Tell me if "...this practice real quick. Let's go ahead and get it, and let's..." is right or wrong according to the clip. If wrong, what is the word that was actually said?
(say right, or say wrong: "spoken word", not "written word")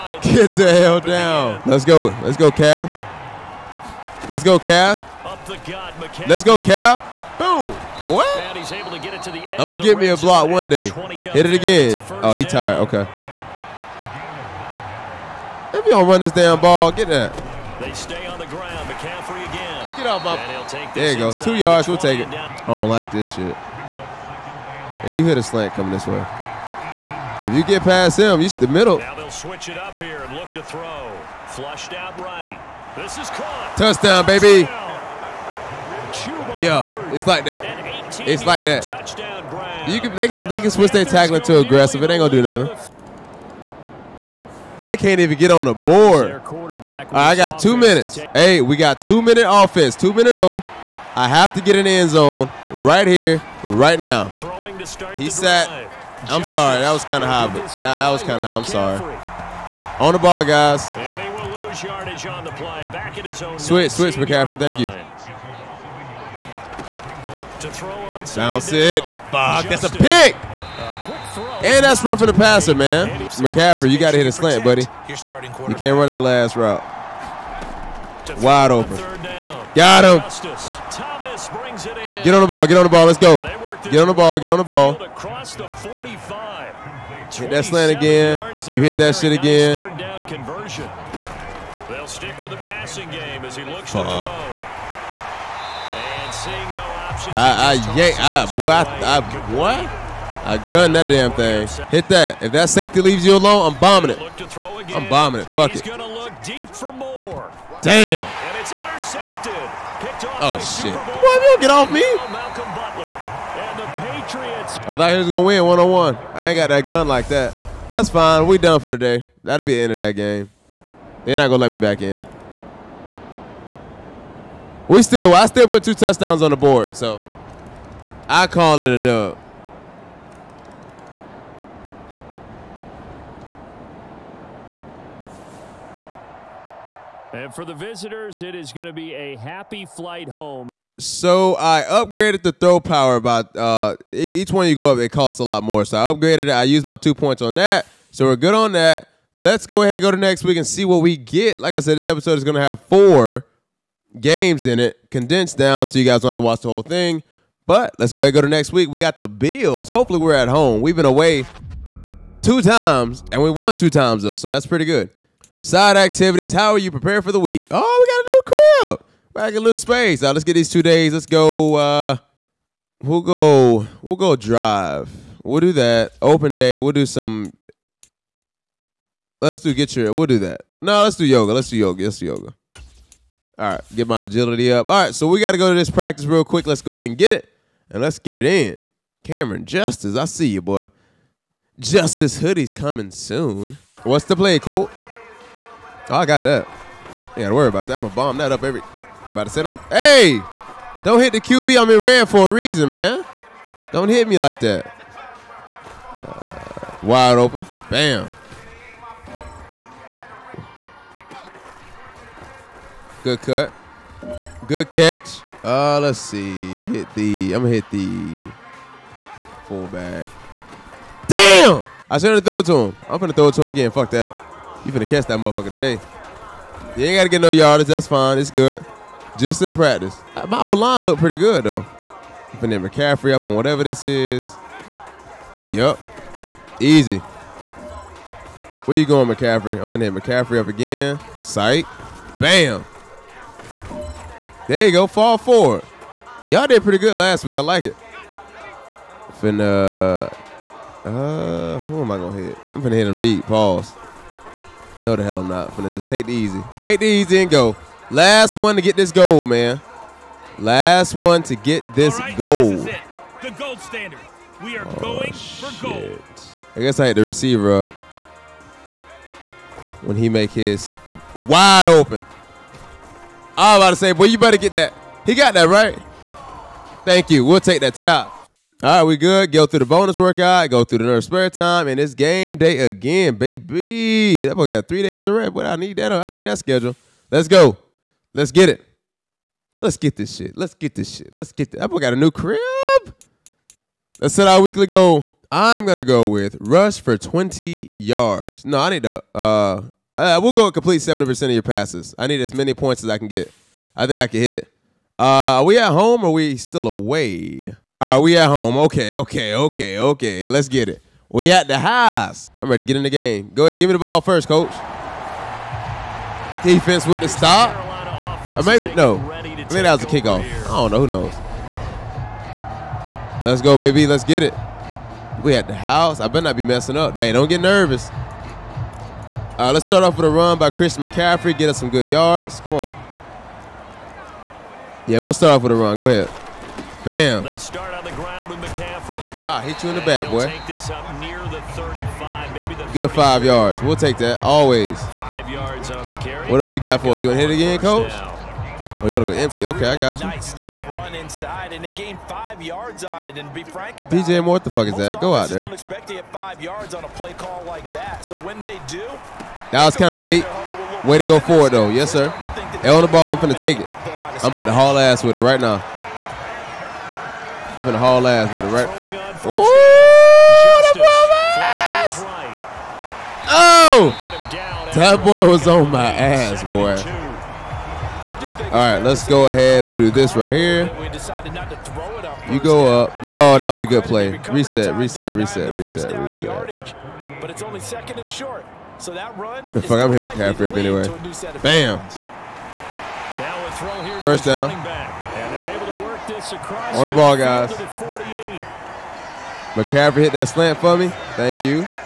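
right.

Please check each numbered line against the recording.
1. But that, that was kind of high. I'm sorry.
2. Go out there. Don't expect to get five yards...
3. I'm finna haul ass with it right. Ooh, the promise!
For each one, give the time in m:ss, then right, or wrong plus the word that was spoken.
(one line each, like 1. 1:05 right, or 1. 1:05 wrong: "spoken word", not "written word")
1. 0:57 right
2. 5:55 right
3. 6:07 right.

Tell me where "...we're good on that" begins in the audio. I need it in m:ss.
2:28.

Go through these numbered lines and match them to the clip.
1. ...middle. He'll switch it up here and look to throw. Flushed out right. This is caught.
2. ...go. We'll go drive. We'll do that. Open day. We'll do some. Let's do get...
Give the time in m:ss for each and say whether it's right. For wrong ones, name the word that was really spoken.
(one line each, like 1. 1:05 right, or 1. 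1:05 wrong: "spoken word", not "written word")
1. 0:28 right
2. 2:53 right.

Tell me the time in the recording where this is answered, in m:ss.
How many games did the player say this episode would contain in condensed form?
2:32.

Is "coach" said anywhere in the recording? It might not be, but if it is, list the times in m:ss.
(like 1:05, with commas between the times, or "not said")
5:14, 5:47.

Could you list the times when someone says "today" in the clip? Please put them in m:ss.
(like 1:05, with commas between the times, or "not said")
1:58, 3:45.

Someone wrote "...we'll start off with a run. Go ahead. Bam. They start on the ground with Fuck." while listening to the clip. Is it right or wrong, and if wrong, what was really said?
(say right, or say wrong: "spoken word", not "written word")
wrong: "McCaffrey", not "Fuck".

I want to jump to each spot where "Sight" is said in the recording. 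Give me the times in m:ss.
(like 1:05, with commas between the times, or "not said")
4:01.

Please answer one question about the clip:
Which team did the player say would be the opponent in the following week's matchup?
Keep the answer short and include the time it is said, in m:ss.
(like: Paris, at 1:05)
Bills, at 2:39.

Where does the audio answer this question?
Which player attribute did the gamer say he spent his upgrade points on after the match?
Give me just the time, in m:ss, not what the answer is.
2:22.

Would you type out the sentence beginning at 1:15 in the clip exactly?
You can't run that last route.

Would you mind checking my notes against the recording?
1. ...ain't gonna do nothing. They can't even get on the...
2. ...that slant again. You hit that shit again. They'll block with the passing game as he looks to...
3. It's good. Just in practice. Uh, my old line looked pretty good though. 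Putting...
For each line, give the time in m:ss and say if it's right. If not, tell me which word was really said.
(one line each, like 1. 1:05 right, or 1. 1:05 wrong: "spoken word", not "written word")
1. 0:42 right
2. 1:27 wrong: "stick", not "block"
3. 3:48 right.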